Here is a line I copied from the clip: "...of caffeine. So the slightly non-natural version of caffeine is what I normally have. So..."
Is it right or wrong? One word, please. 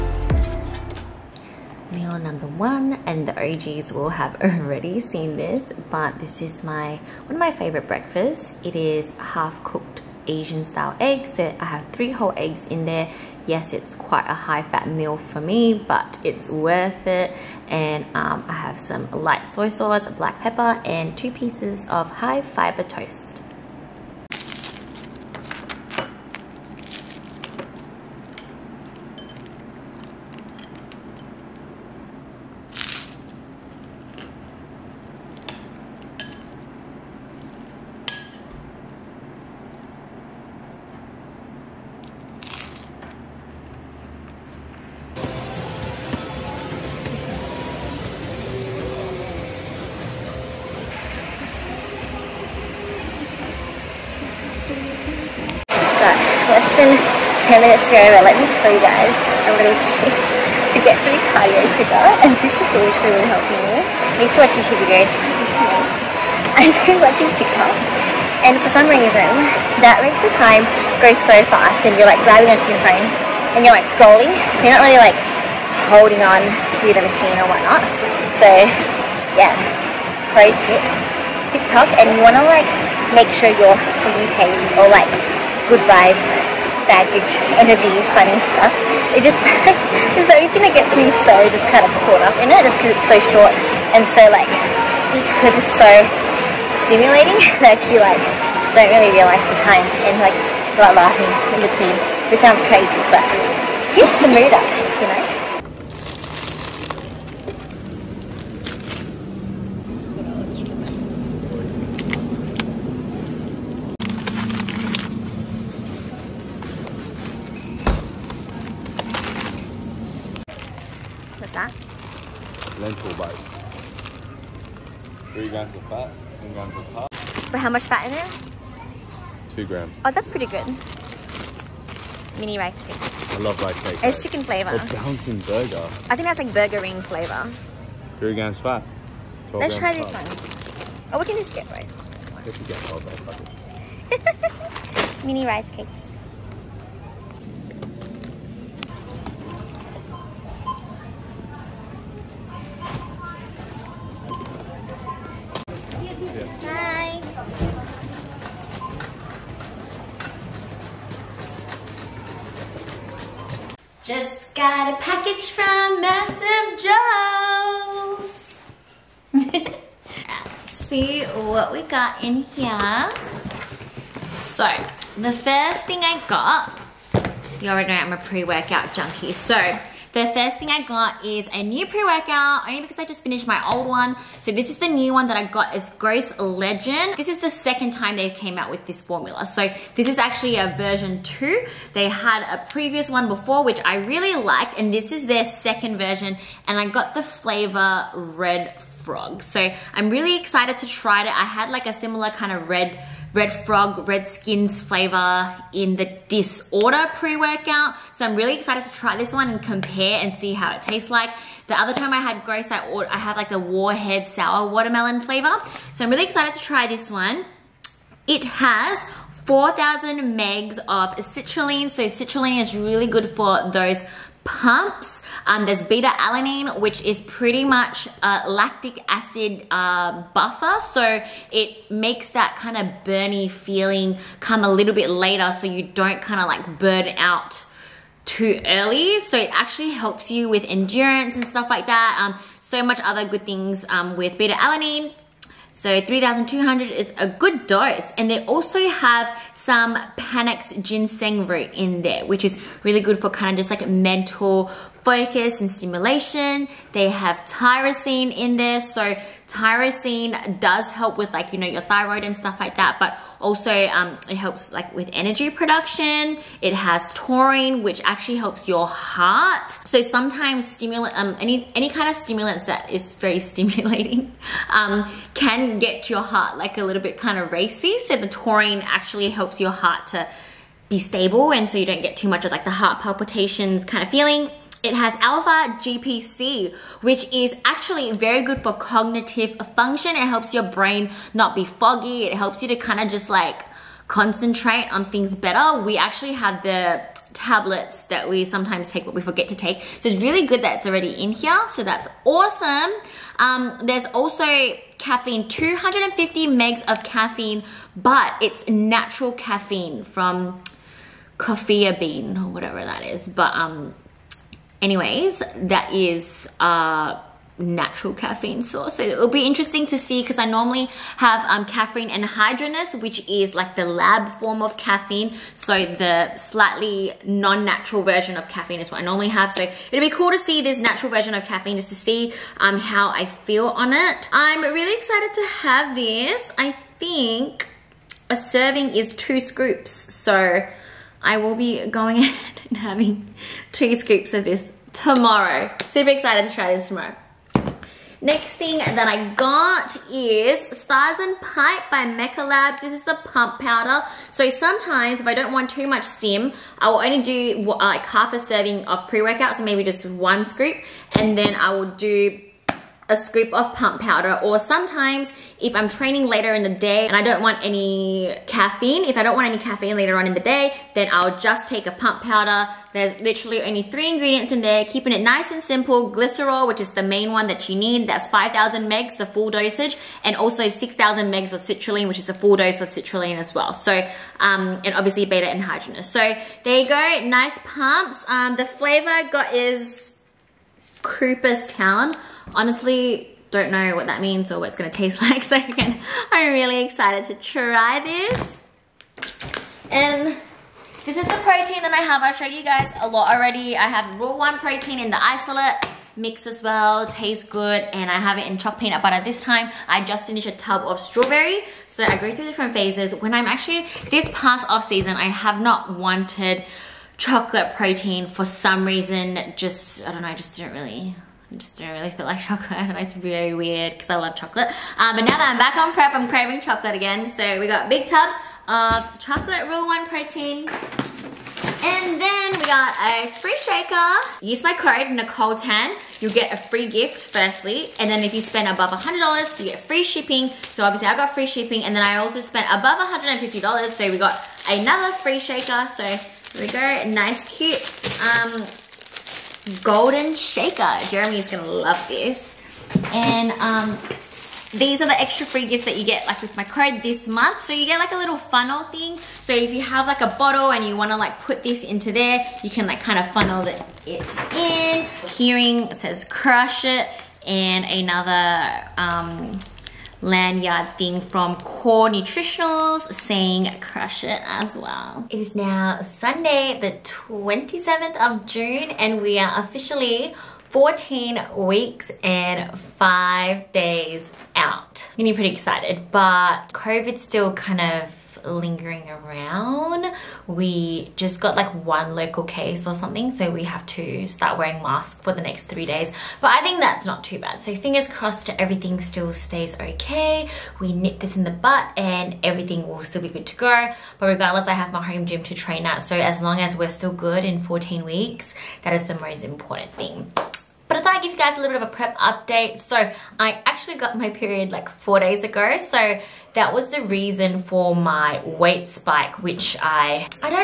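right.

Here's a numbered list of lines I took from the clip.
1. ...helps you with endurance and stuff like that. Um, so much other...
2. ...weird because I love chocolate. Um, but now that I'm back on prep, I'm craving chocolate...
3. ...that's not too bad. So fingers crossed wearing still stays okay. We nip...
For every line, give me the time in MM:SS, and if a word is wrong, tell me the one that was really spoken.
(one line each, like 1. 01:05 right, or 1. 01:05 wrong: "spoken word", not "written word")
1. 03:59 right
2. 07:03 right
3. 08:16 wrong: "everything", not "wearing".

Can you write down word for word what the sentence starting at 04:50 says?
It helps your brain not be foggy.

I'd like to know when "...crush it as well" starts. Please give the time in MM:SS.
07:53.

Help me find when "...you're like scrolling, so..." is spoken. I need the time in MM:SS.
01:13.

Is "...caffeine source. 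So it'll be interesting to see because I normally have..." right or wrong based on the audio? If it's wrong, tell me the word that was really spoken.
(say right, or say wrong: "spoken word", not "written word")
right.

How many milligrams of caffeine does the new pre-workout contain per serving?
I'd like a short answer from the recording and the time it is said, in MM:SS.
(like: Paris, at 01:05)
250, at 05:05.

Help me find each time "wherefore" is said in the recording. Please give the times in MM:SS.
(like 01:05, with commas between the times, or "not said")
not said.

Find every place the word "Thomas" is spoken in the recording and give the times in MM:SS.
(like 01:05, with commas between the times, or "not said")
not said.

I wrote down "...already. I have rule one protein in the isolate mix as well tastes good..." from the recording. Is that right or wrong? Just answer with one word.
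right.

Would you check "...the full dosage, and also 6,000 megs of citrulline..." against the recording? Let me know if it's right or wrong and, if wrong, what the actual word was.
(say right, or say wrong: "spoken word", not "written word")
right.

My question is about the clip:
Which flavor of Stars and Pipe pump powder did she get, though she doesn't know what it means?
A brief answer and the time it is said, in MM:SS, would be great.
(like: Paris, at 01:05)
Cooperstown, at 06:31.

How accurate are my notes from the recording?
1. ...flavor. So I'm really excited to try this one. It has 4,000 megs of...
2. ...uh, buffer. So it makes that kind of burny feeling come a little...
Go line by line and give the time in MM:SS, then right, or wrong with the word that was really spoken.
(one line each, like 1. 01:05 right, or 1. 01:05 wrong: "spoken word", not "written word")
1. 03:35 right
2. 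03:49 right.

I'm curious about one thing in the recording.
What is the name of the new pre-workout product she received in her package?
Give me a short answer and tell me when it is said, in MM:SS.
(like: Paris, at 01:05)
Ghost Legend, at 03:05.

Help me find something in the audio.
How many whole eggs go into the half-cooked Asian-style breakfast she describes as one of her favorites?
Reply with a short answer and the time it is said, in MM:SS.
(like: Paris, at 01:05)
3, at 00:11.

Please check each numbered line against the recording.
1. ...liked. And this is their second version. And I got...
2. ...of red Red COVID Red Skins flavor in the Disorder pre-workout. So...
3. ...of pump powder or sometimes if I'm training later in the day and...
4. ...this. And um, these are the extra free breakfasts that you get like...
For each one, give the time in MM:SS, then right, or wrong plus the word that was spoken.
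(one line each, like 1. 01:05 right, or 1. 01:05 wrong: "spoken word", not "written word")
1. 03:14 right
2. 03:22 wrong: "Frog", not "COVID"
3. 06:03 right
4. 07:32 wrong: "gifts", not "breakfasts".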